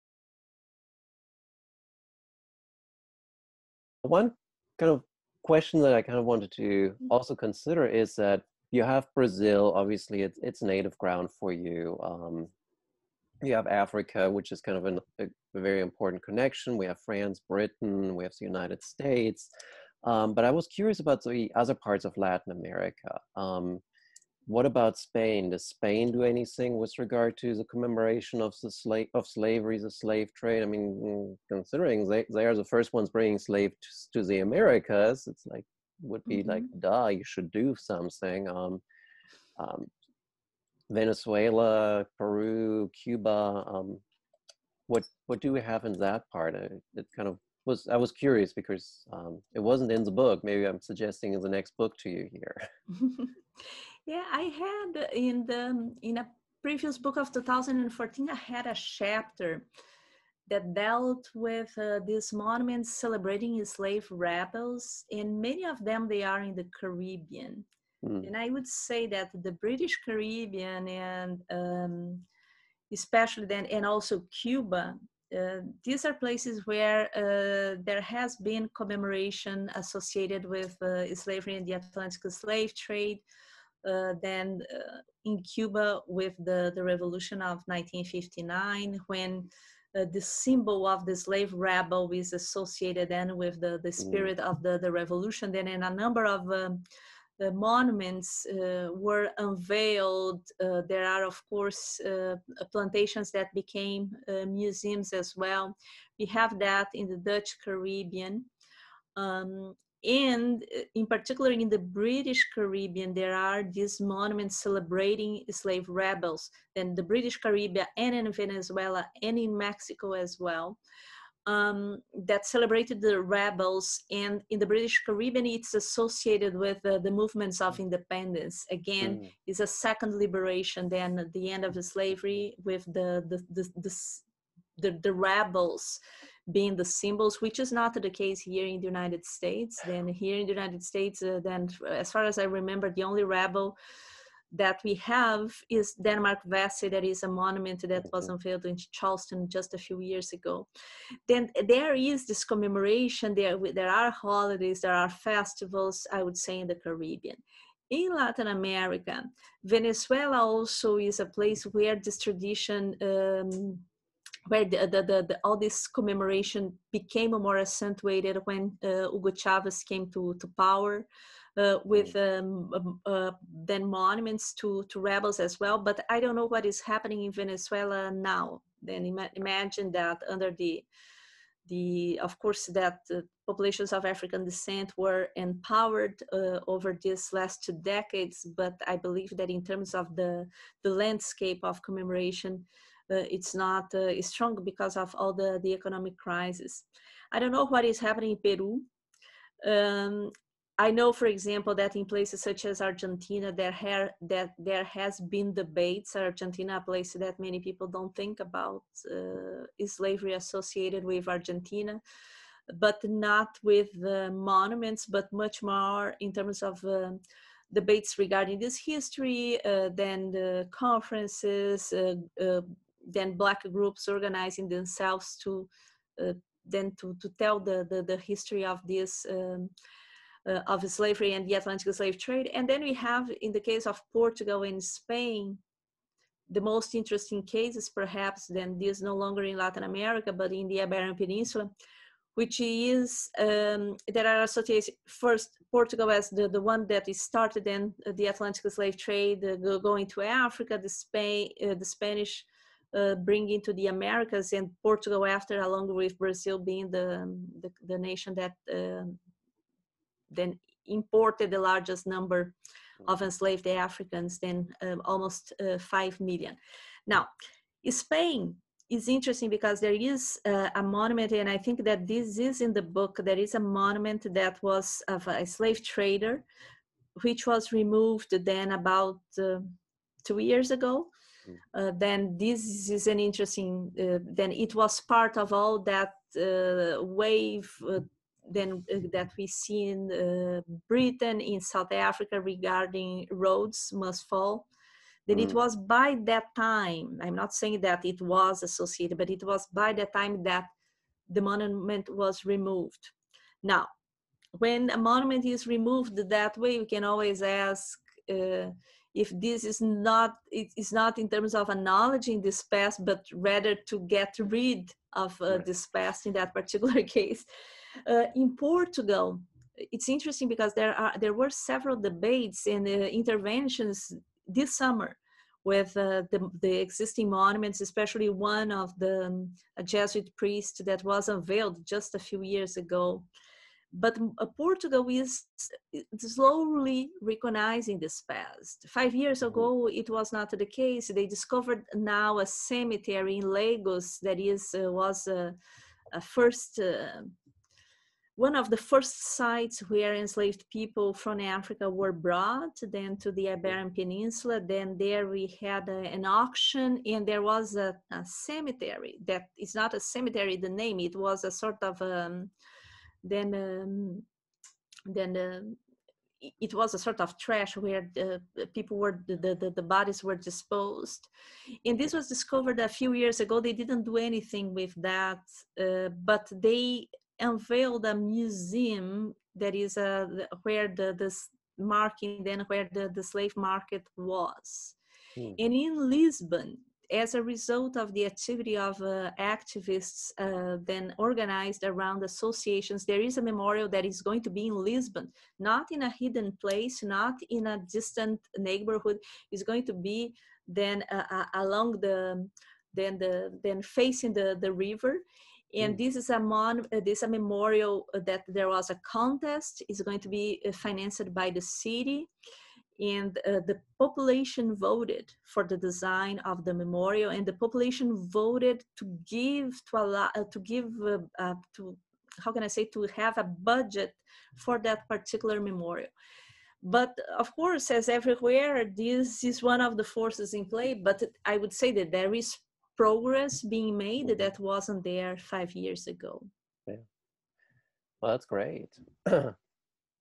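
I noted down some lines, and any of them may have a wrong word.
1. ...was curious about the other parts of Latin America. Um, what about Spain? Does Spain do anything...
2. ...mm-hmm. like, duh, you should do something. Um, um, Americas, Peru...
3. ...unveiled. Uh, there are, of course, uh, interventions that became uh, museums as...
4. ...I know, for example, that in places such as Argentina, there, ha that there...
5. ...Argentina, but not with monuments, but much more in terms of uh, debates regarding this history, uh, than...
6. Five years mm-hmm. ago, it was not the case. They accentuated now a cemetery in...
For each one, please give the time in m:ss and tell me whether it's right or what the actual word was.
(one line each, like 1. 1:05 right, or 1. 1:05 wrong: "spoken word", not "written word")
1. 0:20 right
2. 0:36 wrong: "Venezuela", not "Americas"
3. 1:39 wrong: "plantations", not "interventions"
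4. 3:20 right
5. 3:31 right
6. 5:38 wrong: "discovered", not "accentuated".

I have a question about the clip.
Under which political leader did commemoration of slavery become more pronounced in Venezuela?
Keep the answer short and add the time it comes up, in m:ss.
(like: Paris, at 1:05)
Hugo Chavez, at 2:49.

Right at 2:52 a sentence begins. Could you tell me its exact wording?
um, um, uh, then monuments to, to rebels as well, but I don't know what is happening in Venezuela now.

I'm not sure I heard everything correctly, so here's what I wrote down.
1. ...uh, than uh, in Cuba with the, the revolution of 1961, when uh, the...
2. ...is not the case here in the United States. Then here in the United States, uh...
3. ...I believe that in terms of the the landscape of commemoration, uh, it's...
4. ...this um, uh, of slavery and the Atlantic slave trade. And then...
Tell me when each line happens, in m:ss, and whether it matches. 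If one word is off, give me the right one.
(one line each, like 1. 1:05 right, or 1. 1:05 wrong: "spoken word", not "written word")
1. 1:23 wrong: "1959", not "1961"
2. 2:17 right
3. 3:08 right
4. 3:48 right.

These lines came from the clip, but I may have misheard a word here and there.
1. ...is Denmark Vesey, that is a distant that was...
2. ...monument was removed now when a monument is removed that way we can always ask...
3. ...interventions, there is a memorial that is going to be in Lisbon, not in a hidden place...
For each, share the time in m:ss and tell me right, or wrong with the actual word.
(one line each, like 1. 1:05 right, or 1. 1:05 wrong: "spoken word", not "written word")
1. 2:25 wrong: "monument", not "distant"
2. 5:01 right
3. 6:32 wrong: "associations", not "interventions".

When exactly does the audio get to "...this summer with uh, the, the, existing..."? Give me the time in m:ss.
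5:24.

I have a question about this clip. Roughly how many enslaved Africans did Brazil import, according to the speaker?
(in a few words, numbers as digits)
almost 5 million.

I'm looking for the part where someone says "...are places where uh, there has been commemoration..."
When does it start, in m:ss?
1:16.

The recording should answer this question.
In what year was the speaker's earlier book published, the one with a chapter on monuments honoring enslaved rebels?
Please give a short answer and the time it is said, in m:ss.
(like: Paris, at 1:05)
2014, at 0:57.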